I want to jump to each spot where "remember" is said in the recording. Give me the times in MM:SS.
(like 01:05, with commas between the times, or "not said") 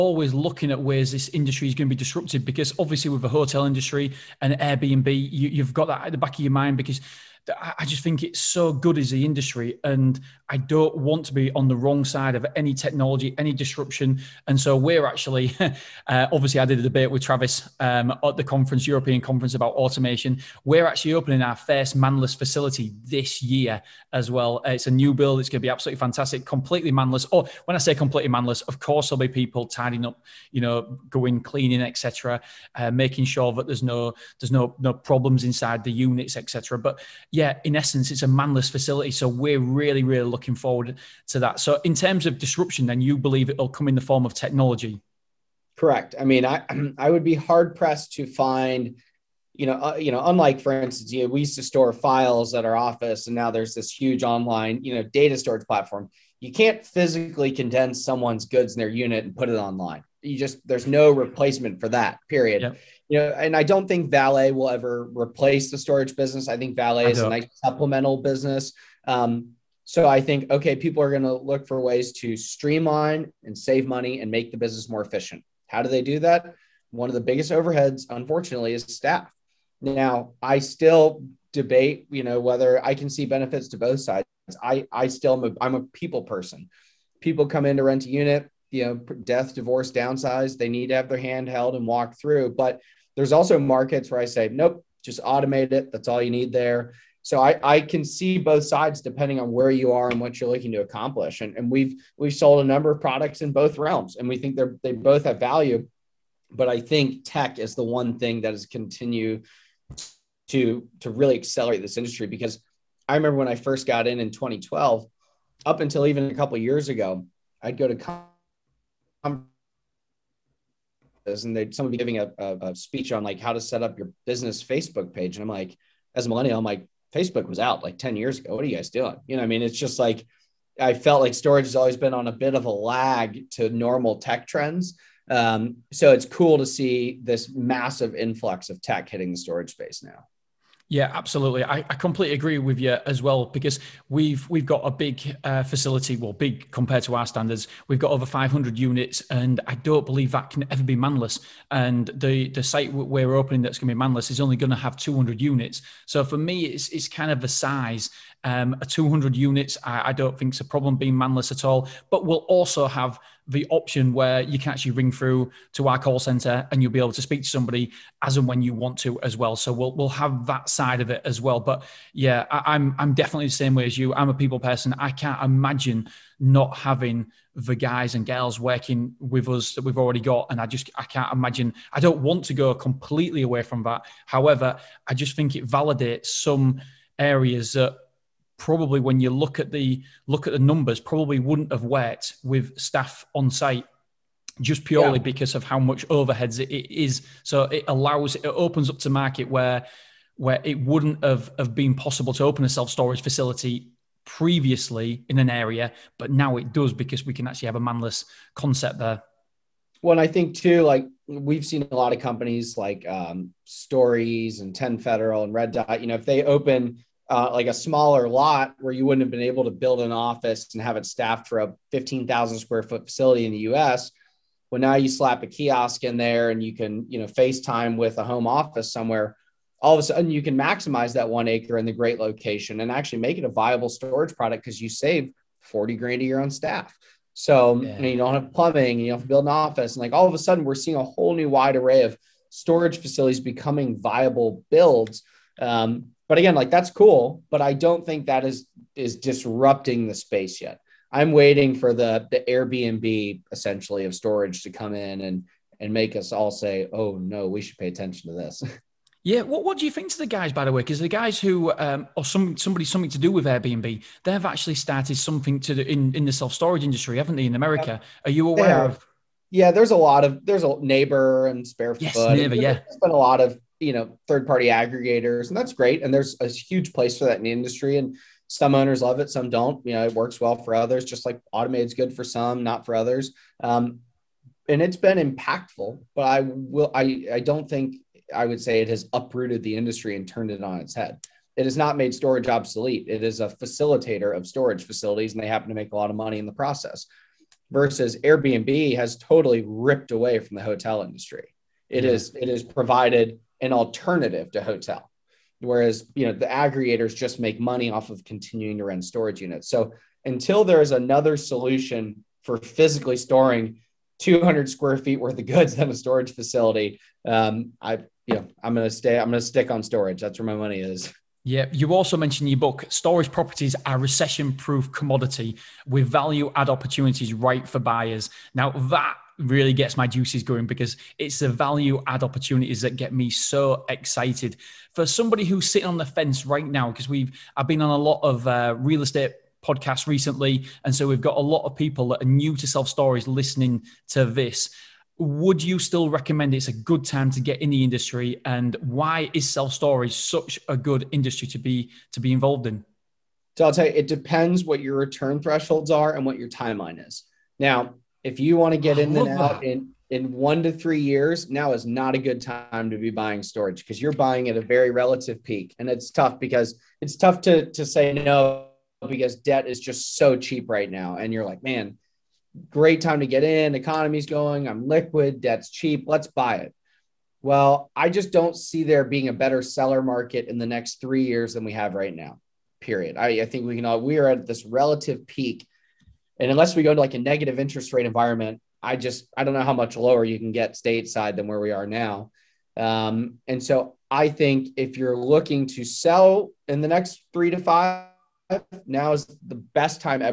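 01:53.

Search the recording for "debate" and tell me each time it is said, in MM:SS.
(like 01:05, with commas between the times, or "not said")
00:16, 01:21.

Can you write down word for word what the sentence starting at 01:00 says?
You just there's no replacement for that.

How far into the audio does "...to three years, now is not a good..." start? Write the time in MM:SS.
06:00.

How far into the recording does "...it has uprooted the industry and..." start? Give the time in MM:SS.
04:48.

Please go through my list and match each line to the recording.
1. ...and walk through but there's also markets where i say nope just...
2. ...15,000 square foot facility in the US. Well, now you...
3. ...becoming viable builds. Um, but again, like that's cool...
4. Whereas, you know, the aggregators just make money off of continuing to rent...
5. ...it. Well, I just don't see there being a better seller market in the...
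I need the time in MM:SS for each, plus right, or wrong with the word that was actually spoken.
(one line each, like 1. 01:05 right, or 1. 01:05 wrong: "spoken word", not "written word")
1. 01:31 right
2. 03:41 right
3. 04:03 right
4. 05:05 right
5. 06:16 right.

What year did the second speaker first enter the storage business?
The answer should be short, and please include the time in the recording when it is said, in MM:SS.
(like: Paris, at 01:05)
2012, at 01:54.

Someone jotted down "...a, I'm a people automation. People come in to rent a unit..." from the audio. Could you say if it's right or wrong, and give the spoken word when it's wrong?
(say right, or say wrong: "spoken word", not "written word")
wrong: "person", not "automation".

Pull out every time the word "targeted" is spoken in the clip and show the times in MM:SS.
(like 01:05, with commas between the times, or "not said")
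not said.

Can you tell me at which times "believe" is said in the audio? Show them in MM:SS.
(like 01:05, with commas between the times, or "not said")
00:43, 02:30.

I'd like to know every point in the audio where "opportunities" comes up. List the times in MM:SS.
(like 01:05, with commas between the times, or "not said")
05:26, 05:32.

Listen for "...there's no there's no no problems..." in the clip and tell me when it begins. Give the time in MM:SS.
00:33.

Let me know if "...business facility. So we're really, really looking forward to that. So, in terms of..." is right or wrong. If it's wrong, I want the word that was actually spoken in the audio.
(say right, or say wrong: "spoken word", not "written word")
wrong: "manless", not "business".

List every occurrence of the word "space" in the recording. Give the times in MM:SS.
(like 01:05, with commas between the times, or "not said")
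02:19, 04:10.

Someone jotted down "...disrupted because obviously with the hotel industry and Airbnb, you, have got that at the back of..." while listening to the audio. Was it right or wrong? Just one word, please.
right.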